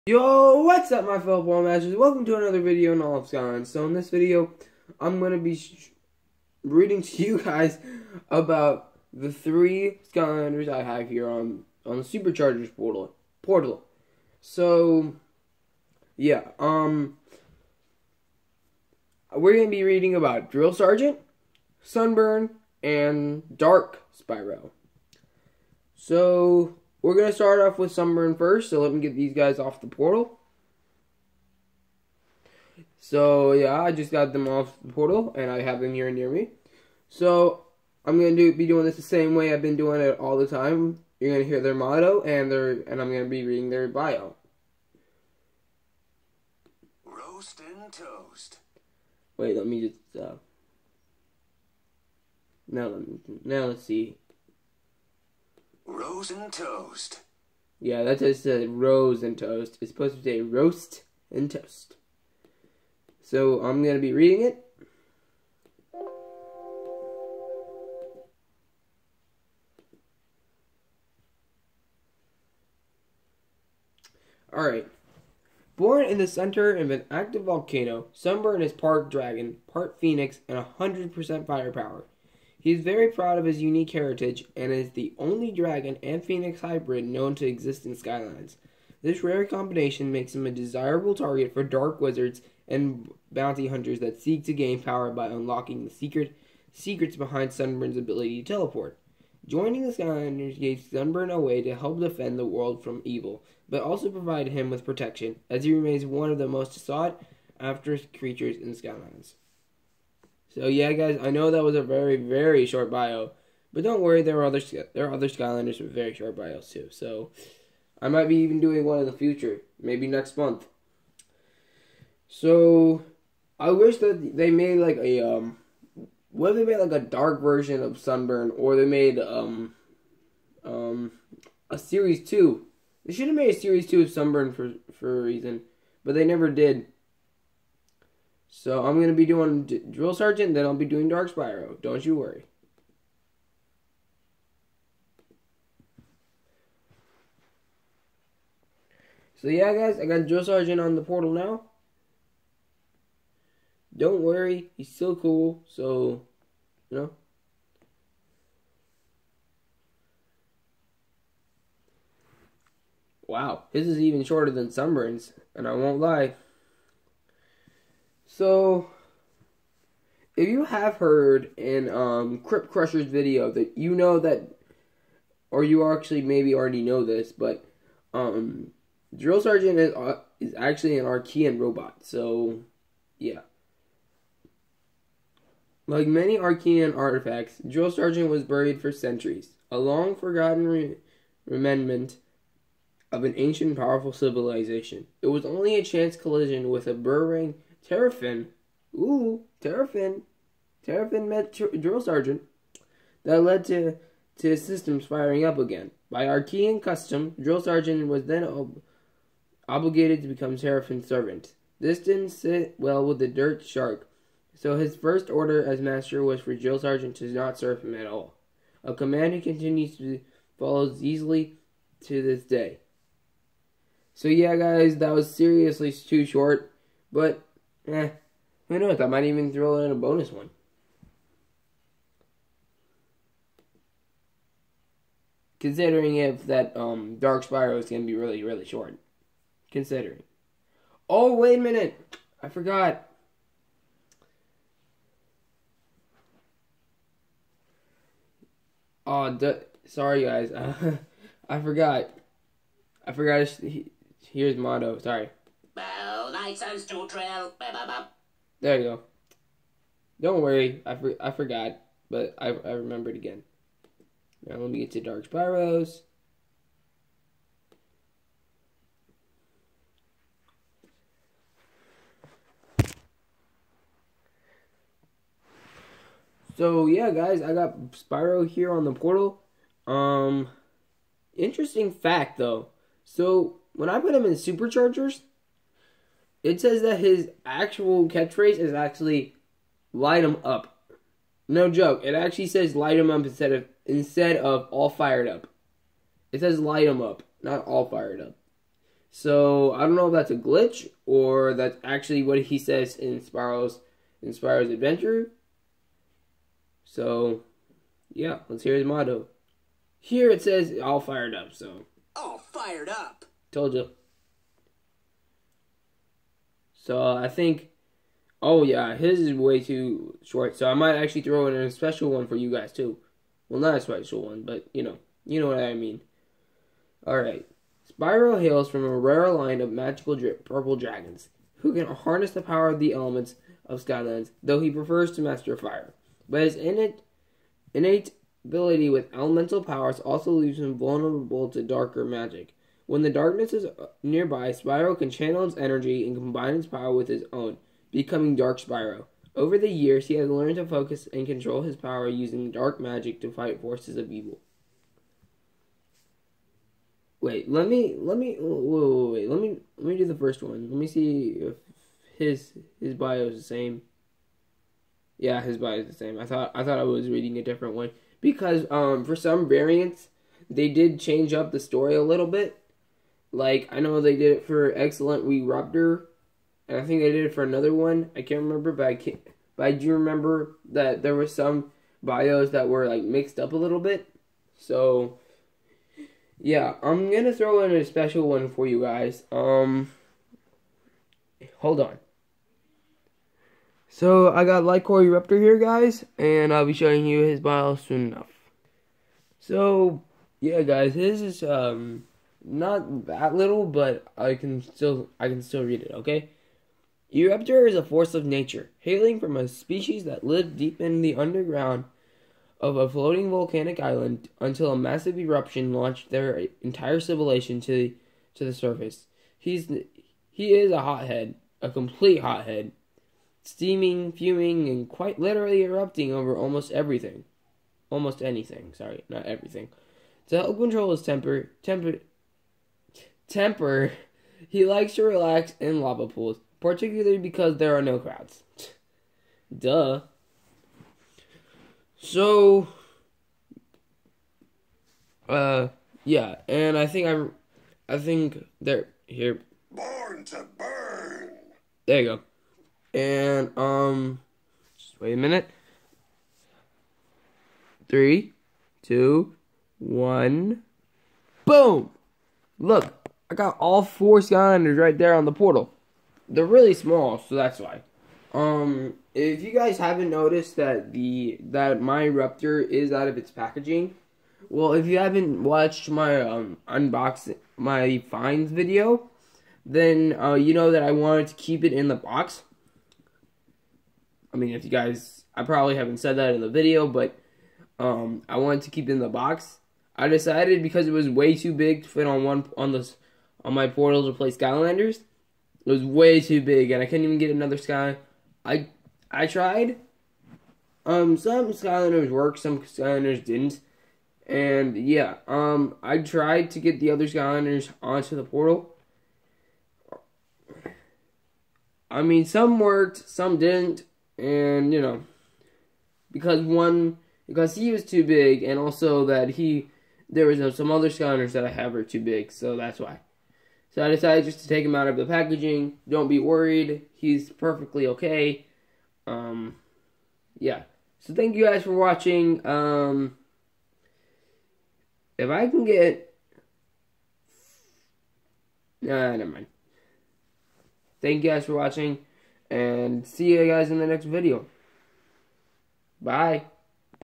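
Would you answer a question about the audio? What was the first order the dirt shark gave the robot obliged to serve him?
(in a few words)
Not serve him at all.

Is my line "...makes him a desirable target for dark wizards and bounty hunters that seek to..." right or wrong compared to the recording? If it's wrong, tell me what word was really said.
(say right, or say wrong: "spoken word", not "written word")
right.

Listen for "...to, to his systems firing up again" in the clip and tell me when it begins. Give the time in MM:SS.
03:23.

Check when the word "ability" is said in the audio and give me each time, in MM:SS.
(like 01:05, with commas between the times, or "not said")
01:37, 05:38.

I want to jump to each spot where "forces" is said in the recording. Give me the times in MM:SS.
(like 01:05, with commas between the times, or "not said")
05:53, 06:47.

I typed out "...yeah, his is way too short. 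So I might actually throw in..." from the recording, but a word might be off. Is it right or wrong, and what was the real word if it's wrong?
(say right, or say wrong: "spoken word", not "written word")
right.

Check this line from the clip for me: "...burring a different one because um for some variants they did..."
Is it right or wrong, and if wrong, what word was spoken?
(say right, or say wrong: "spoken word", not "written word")
wrong: "reading", not "burring".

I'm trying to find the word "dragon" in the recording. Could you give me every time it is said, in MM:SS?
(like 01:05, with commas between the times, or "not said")
01:19, 01:25, 05:30.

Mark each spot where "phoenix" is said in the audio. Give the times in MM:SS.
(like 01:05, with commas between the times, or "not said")
01:19, 01:26.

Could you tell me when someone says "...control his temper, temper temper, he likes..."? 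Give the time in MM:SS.
07:10.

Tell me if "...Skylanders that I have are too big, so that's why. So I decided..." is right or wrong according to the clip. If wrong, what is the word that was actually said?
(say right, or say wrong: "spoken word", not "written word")
right.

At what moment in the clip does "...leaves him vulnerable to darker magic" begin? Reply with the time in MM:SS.
05:40.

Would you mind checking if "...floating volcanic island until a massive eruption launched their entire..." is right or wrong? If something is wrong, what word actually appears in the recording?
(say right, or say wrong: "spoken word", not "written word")
right.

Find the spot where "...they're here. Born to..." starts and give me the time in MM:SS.
07:28.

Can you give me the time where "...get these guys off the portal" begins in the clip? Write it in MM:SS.
00:29.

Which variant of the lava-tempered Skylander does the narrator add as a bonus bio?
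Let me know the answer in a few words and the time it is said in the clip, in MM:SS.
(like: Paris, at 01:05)
Light Core Eruptor, at 06:34.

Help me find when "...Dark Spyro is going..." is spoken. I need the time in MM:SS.
03:57.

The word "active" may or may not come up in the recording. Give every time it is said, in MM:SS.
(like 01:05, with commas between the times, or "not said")
01:17.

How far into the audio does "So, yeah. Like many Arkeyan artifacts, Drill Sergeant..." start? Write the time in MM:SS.
03:02.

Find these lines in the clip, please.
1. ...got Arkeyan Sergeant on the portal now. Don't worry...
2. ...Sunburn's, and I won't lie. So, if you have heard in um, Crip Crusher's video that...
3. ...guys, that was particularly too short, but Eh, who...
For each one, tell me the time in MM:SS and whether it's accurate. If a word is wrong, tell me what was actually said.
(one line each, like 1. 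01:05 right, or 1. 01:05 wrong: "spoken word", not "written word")
1. 02:30 wrong: "Drill", not "Arkeyan"
2. 02:44 right
3. 03:44 wrong: "seriously", not "particularly".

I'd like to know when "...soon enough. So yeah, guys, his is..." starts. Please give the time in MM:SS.
06:37.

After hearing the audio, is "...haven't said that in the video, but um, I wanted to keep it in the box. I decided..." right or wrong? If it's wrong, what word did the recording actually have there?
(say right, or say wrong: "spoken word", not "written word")
right.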